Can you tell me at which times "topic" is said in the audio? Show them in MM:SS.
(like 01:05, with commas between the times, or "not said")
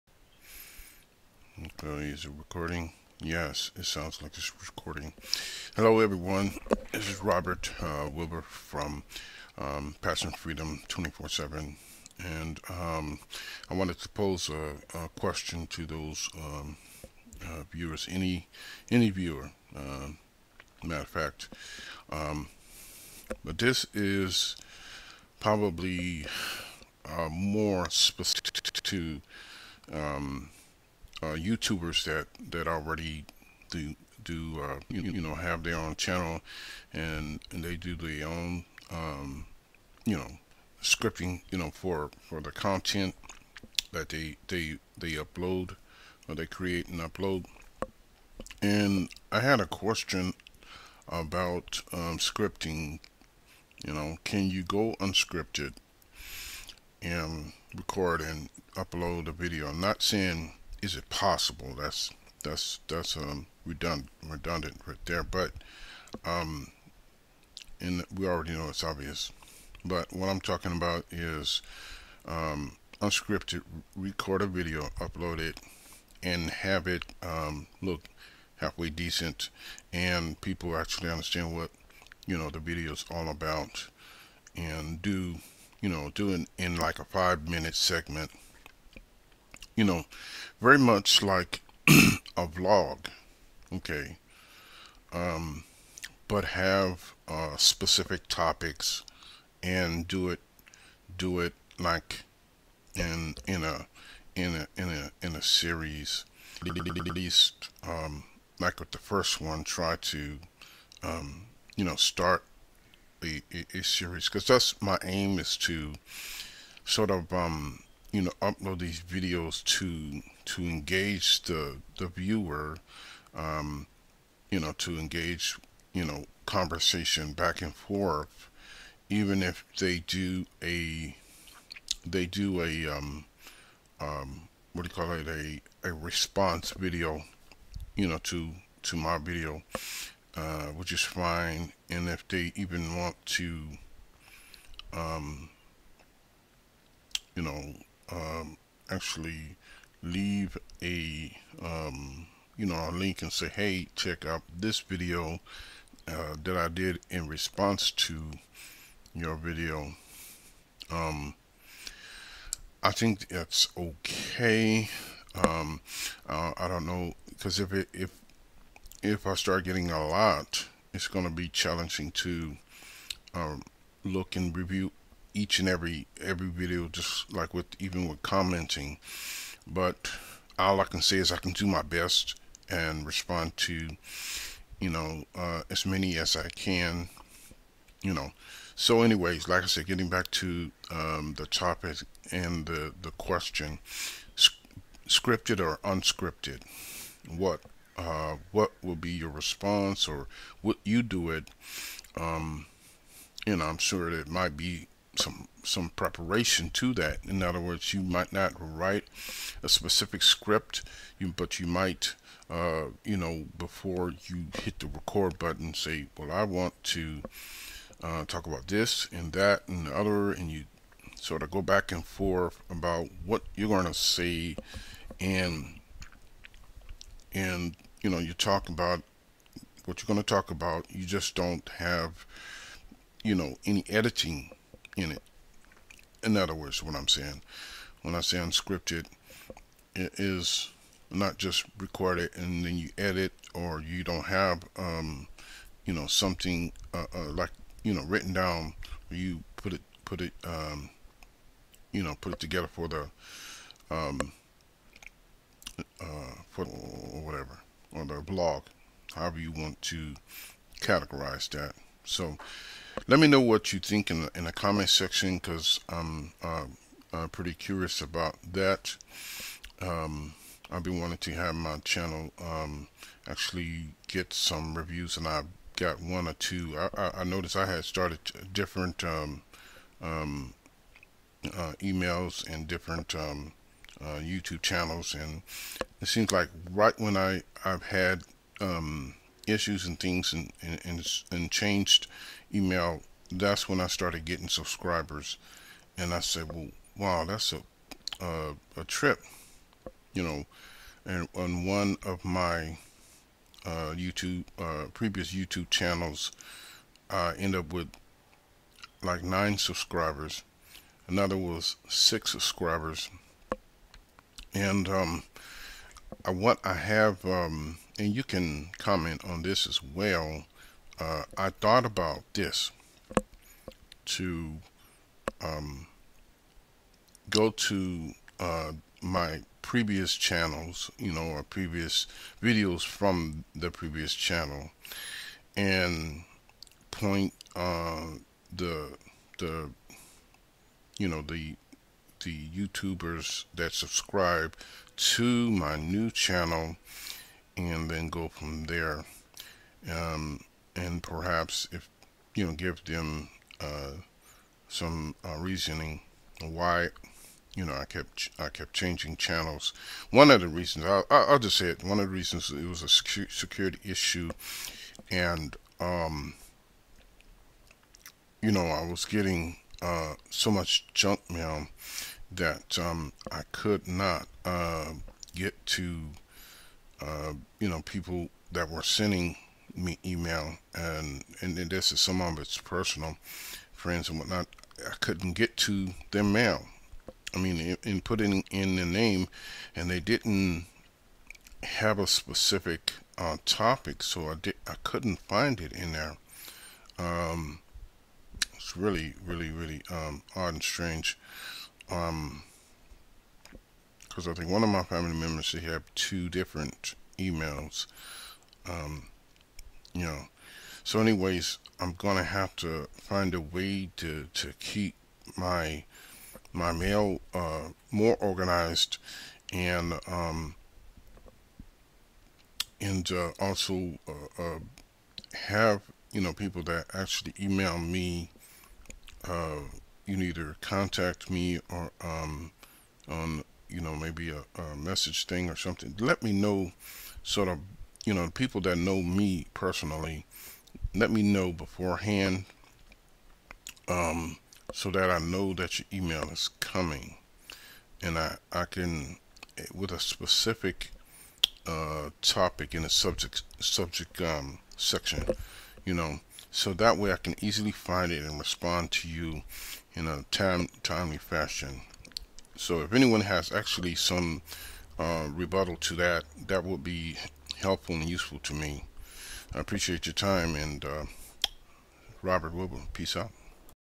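01:38, 03:11, 06:33, 07:32.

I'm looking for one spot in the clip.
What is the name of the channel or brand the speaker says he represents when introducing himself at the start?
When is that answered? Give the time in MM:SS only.
00:09.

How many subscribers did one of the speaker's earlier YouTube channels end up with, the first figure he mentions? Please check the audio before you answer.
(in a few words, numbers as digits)
9.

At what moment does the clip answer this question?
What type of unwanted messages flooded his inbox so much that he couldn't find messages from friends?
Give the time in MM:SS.
06:10.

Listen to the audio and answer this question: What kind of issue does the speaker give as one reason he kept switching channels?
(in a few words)
Security issue.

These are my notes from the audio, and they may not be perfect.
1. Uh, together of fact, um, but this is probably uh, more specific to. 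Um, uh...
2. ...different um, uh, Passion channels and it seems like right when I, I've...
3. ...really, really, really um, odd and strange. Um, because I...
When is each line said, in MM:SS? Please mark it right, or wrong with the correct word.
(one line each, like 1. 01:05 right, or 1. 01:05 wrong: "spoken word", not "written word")
1. 00:19 wrong: "matter", not "together"
2. 04:42 wrong: "YouTube", not "Passion"
3. 06:38 right.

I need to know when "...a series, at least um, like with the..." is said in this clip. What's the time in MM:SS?
01:45.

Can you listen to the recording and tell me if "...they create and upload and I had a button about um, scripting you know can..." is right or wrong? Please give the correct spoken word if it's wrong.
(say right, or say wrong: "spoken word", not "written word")
wrong: "question", not "button".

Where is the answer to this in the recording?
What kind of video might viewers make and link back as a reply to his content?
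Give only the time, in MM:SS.
02:15.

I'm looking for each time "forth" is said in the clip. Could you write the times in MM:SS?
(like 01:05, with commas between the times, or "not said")
02:07, 03:42.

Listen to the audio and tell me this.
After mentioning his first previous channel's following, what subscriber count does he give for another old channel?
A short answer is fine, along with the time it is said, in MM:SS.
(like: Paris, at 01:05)
6, at 05:11.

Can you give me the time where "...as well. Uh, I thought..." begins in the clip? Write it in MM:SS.
05:19.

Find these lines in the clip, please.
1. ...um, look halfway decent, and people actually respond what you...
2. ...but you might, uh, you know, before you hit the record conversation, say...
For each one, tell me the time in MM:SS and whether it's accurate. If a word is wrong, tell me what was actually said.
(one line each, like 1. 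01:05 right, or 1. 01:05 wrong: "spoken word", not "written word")
1. 01:17 wrong: "understand", not "respond"
2. 03:31 wrong: "button", not "conversation".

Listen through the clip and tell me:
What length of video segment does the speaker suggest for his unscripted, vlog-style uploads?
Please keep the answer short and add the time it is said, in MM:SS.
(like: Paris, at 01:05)
5 minute, at 01:27.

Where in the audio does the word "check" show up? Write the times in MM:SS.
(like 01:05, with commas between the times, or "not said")
02:33.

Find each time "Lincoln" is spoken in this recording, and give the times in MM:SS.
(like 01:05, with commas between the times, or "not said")
not said.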